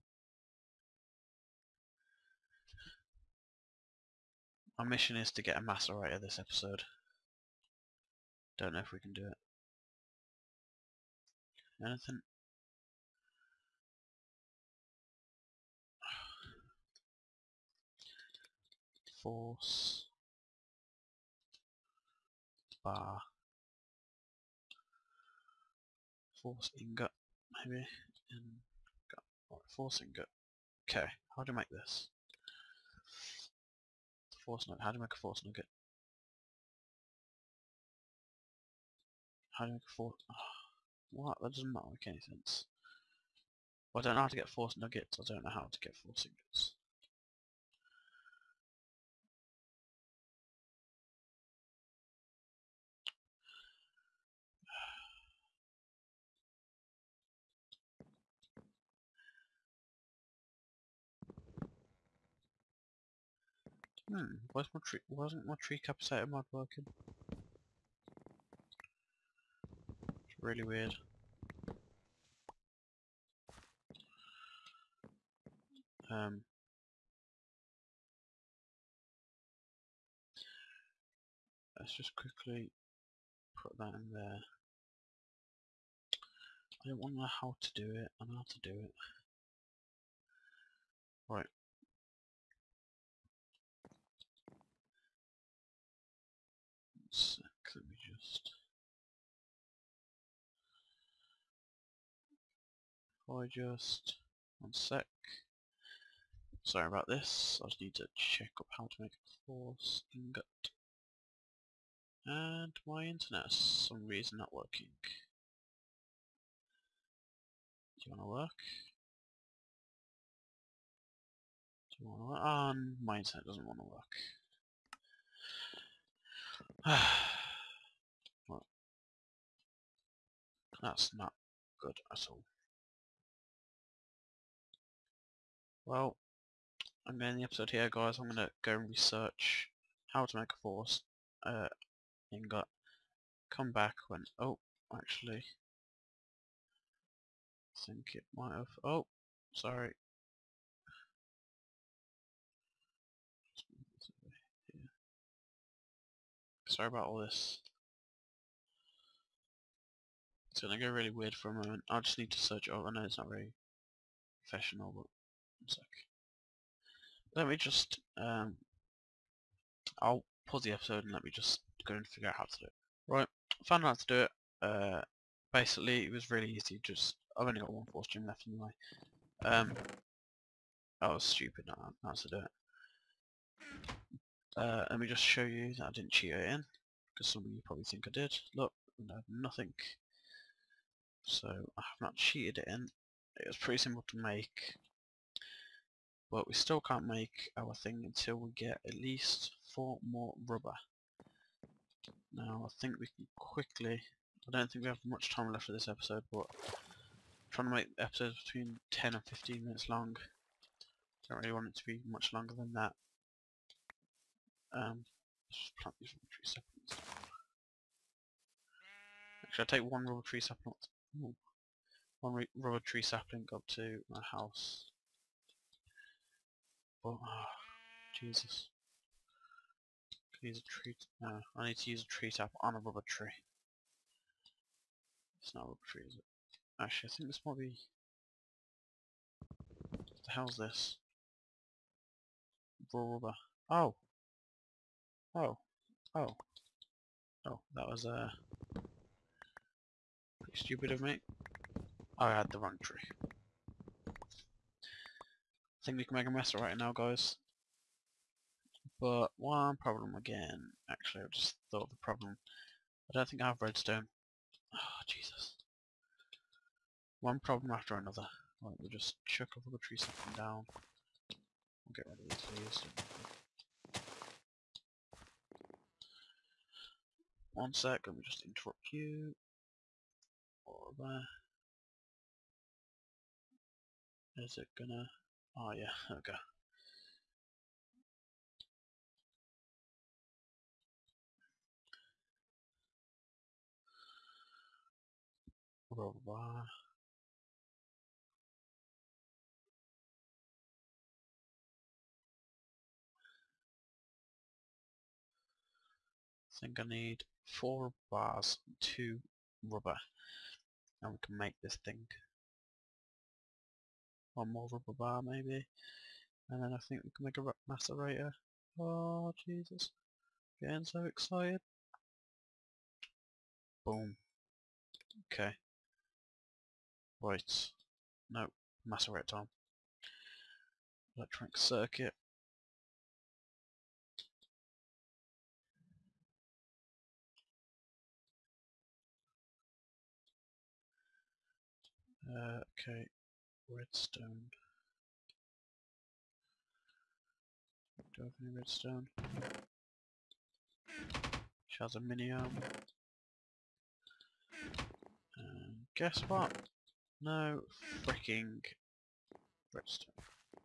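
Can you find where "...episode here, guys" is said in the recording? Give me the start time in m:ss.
2:17.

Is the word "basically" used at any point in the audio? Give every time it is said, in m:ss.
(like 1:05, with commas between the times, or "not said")
2:55.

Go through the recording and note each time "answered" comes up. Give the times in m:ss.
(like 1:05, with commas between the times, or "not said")
not said.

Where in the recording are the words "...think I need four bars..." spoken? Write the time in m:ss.
5:06.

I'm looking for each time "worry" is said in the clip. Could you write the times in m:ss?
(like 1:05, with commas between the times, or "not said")
not said.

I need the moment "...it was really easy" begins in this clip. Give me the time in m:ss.
2:56.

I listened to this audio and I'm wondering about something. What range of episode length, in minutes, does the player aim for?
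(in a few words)
10 to 15 minutes.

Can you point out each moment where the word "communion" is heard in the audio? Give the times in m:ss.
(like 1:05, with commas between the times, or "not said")
not said.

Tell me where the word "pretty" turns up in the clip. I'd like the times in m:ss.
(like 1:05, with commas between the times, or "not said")
3:13, 4:10.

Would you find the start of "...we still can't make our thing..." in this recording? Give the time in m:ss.
3:16.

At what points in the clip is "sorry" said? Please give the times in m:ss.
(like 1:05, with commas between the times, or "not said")
1:46, 2:29, 2:36.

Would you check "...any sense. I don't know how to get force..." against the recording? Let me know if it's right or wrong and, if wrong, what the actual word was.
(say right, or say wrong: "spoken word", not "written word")
right.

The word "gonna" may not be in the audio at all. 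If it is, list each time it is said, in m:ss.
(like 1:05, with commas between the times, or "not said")
2:40, 4:44.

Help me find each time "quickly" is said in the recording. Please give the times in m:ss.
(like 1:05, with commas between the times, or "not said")
1:22, 3:23.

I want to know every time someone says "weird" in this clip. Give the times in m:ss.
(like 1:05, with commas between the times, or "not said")
1:10, 2:41.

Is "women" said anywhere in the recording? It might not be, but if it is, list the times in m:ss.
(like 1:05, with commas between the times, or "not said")
not said.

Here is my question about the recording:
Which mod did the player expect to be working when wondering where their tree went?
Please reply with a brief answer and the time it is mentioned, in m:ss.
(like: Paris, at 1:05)
Tree capacitator mod, at 1:05.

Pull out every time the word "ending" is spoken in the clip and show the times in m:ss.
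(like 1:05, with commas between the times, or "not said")
2:17.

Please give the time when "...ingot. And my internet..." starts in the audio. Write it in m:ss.
1:50.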